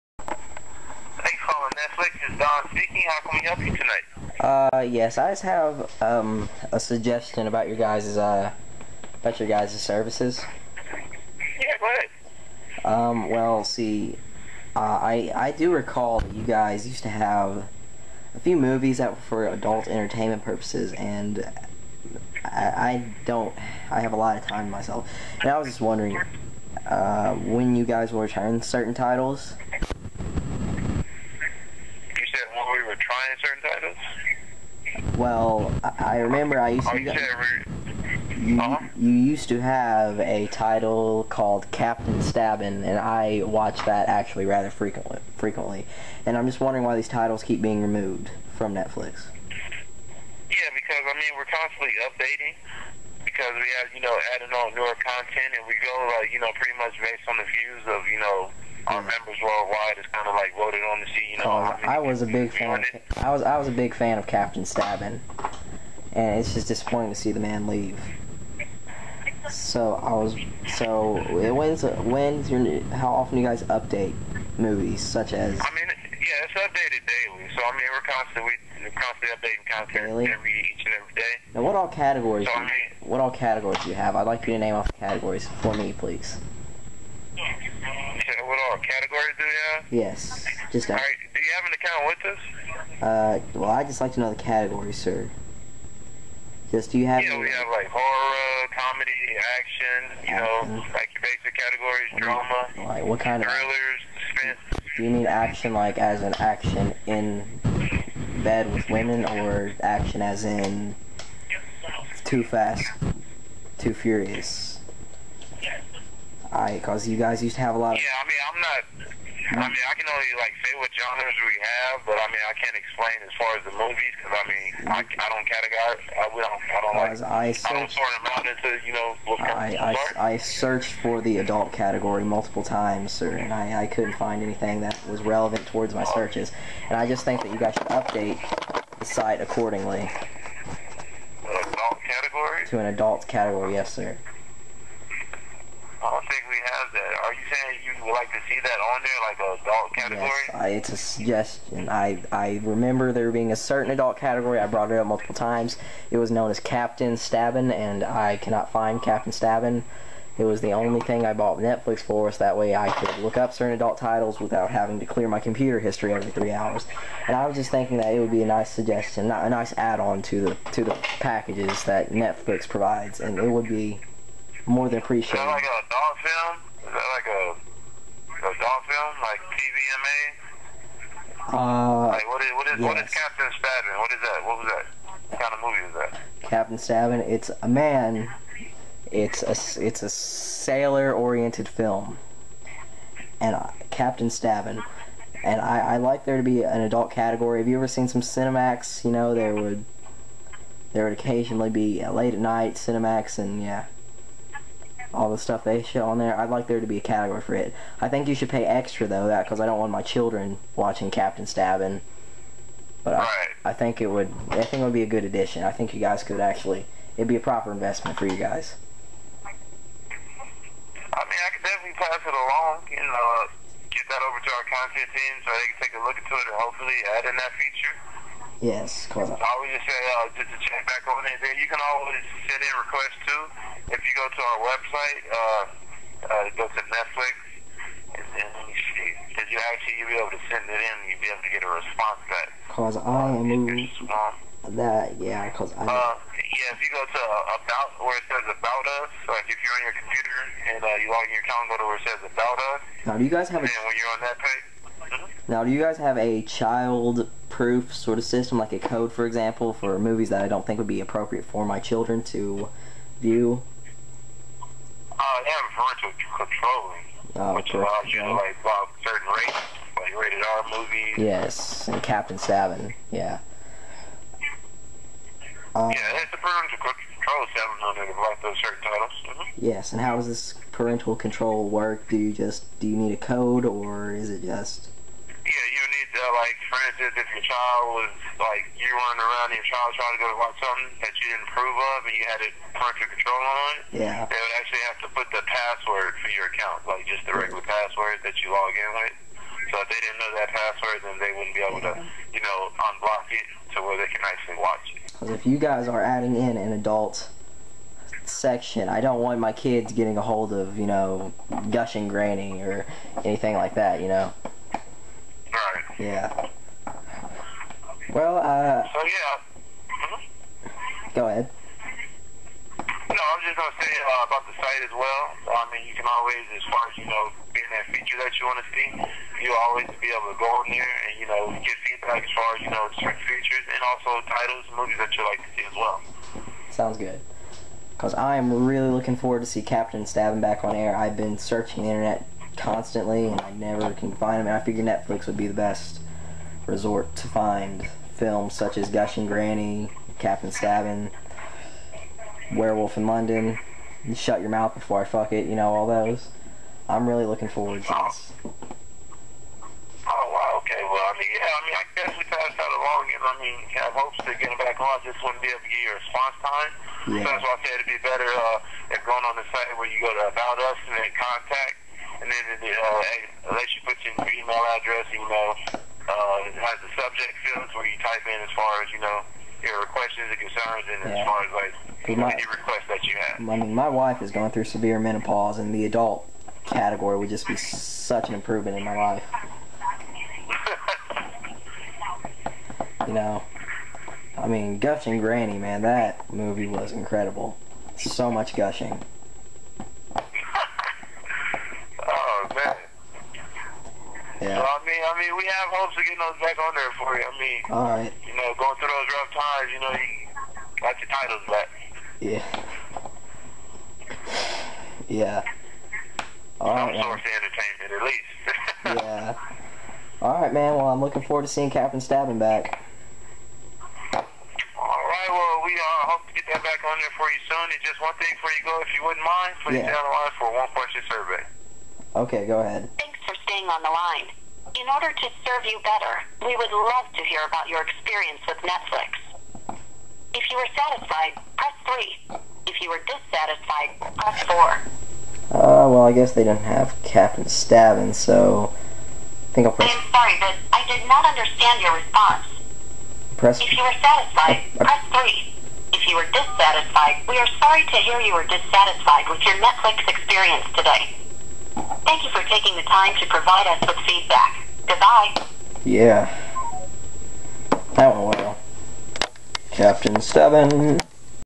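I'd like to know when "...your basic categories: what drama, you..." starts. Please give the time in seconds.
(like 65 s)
101 s.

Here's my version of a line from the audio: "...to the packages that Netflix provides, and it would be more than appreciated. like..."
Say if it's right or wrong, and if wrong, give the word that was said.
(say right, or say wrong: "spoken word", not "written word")
right.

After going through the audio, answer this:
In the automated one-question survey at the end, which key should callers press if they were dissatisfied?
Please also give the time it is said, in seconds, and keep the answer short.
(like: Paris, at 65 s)
4, at 444 s.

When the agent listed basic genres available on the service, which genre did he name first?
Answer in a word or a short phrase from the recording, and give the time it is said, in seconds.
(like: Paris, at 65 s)
horror, at 97 s.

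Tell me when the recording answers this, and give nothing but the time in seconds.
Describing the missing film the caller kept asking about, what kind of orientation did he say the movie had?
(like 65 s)
190 s.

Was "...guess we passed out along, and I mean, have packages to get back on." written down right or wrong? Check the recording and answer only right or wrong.
wrong.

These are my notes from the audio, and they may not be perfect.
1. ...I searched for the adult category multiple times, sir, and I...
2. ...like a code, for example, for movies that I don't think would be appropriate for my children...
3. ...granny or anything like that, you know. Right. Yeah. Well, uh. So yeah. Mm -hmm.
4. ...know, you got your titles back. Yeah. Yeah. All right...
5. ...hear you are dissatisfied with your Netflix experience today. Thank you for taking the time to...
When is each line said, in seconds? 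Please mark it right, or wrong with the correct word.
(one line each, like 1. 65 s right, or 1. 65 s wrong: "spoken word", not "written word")
1. 130 s right
2. 258 s right
3. 312 s right
4. 409 s right
5. 457 s right.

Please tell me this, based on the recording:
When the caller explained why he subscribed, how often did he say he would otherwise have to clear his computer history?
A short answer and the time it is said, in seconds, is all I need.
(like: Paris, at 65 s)
every three hours, at 166 s.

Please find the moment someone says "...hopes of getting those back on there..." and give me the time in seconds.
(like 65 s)
405 s.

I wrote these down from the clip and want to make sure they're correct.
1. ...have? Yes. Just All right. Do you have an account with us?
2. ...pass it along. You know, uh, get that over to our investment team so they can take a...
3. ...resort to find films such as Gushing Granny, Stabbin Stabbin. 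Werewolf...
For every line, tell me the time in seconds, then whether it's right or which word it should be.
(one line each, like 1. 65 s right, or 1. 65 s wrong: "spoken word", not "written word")
1. 89 s right
2. 221 s wrong: "content", not "investment"
3. 346 s wrong: "Captain", not "Stabbin".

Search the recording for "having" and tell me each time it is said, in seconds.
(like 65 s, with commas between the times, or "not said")
164 s.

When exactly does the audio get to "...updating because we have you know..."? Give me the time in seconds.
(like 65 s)
52 s.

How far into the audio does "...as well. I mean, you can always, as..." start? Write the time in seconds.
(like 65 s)
324 s.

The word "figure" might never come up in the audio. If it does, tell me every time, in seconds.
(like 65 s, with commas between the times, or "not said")
344 s.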